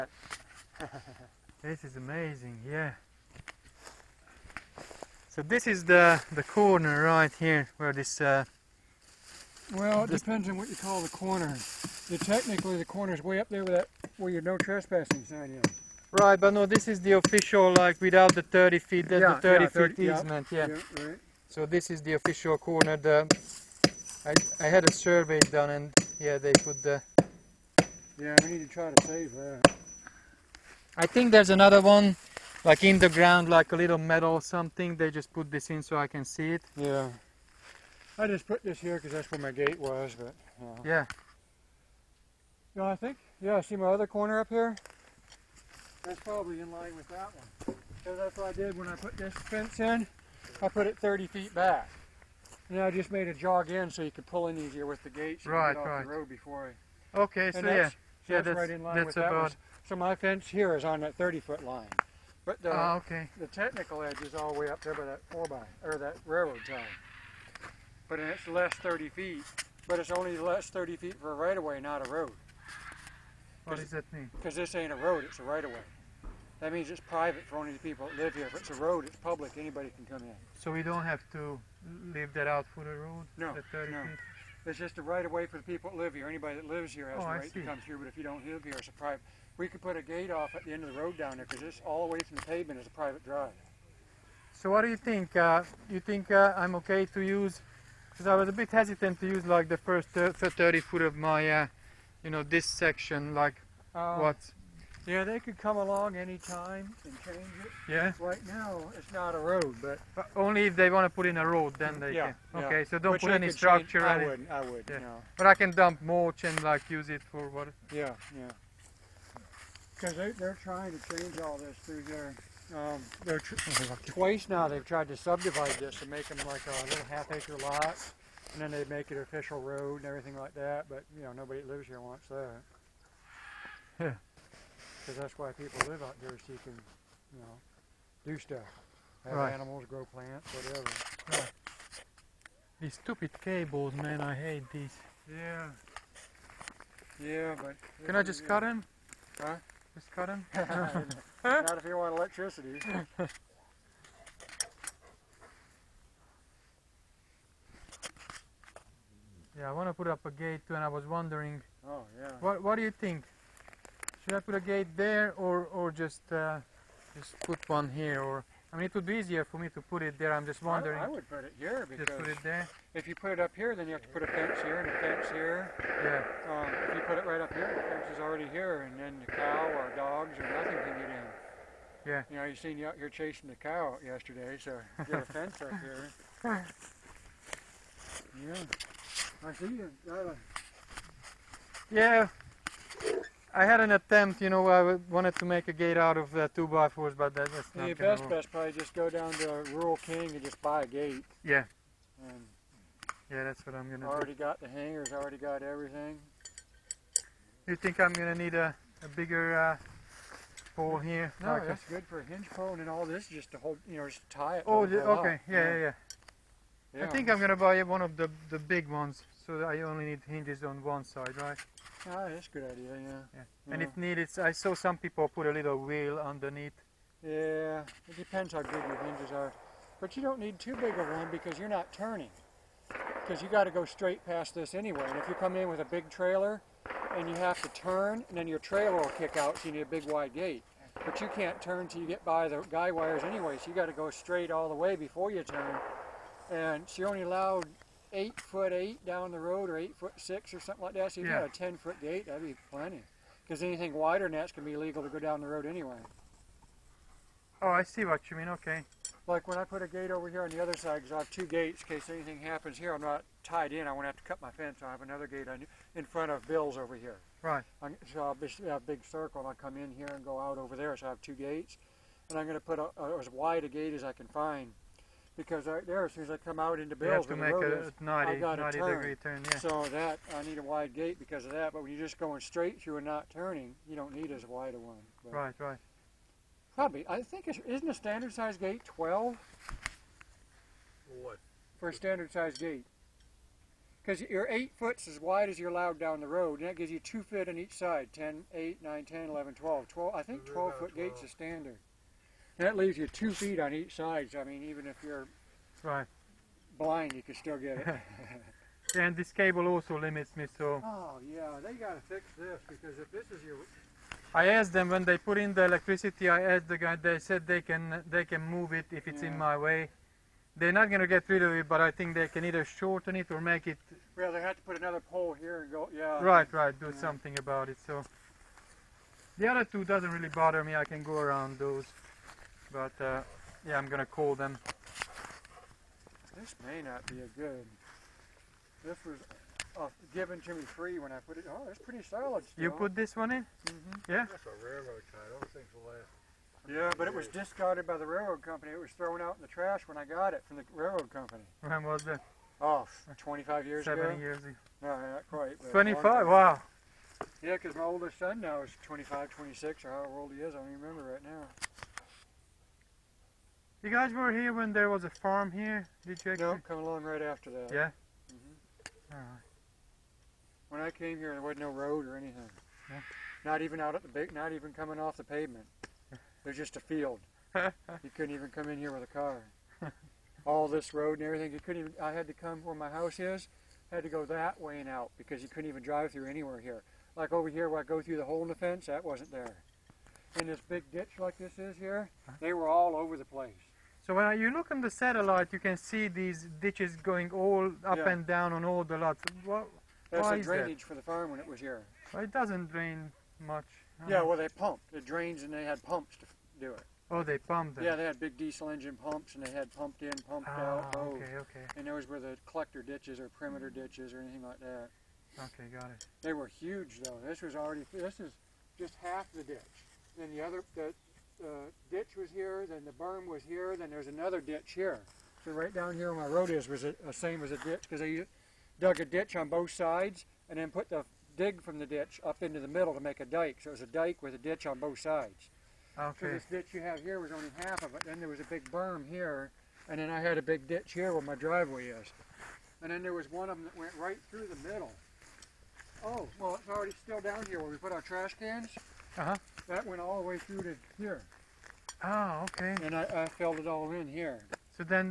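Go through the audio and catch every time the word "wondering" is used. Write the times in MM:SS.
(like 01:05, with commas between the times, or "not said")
02:41, 02:50.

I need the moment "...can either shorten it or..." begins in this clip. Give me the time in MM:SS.
05:22.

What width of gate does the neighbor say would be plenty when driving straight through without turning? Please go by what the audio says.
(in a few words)
10 feet.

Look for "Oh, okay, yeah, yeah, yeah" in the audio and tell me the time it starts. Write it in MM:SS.
03:34.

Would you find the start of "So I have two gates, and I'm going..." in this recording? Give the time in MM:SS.
04:30.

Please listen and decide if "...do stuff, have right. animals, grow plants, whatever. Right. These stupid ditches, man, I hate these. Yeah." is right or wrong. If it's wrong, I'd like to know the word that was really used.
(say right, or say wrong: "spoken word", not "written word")
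wrong: "cables", not "ditches".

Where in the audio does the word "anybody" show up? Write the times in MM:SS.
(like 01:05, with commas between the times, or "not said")
01:19, 01:26.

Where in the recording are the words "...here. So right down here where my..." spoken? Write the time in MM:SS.
07:04.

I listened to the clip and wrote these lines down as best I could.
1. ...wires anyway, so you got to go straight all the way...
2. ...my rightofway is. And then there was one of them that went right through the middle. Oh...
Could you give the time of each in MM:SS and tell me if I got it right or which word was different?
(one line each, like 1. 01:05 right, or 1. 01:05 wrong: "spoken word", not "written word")
1. 04:02 right
2. 07:21 wrong: "driveway", not "rightofway".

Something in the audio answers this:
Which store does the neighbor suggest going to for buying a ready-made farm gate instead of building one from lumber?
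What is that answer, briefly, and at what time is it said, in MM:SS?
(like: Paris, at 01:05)
Rural King, at 03:19.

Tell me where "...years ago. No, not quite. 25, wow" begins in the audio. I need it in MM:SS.
05:54.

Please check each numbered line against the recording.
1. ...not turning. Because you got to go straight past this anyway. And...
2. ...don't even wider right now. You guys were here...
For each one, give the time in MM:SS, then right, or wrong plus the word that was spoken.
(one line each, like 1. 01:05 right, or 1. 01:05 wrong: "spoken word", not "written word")
1. 03:51 right
2. 06:00 wrong: "remember", not "wider".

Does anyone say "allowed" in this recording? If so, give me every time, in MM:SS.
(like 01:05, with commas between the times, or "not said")
04:07, 04:55.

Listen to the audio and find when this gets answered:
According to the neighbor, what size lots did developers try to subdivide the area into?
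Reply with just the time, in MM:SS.
02:07.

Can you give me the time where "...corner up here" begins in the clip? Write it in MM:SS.
00:44.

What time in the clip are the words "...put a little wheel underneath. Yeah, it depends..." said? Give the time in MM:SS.
03:45.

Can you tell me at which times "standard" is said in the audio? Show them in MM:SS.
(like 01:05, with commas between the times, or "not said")
04:47, 04:51, 05:01.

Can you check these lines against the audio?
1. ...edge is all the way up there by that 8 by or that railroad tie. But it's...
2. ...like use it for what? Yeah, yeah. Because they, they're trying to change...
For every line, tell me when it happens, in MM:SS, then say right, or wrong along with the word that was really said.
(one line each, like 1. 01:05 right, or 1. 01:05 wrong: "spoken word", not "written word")
1. 01:04 wrong: "4", not "8"
2. 01:56 right.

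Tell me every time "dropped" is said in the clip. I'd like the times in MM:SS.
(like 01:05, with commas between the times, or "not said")
not said.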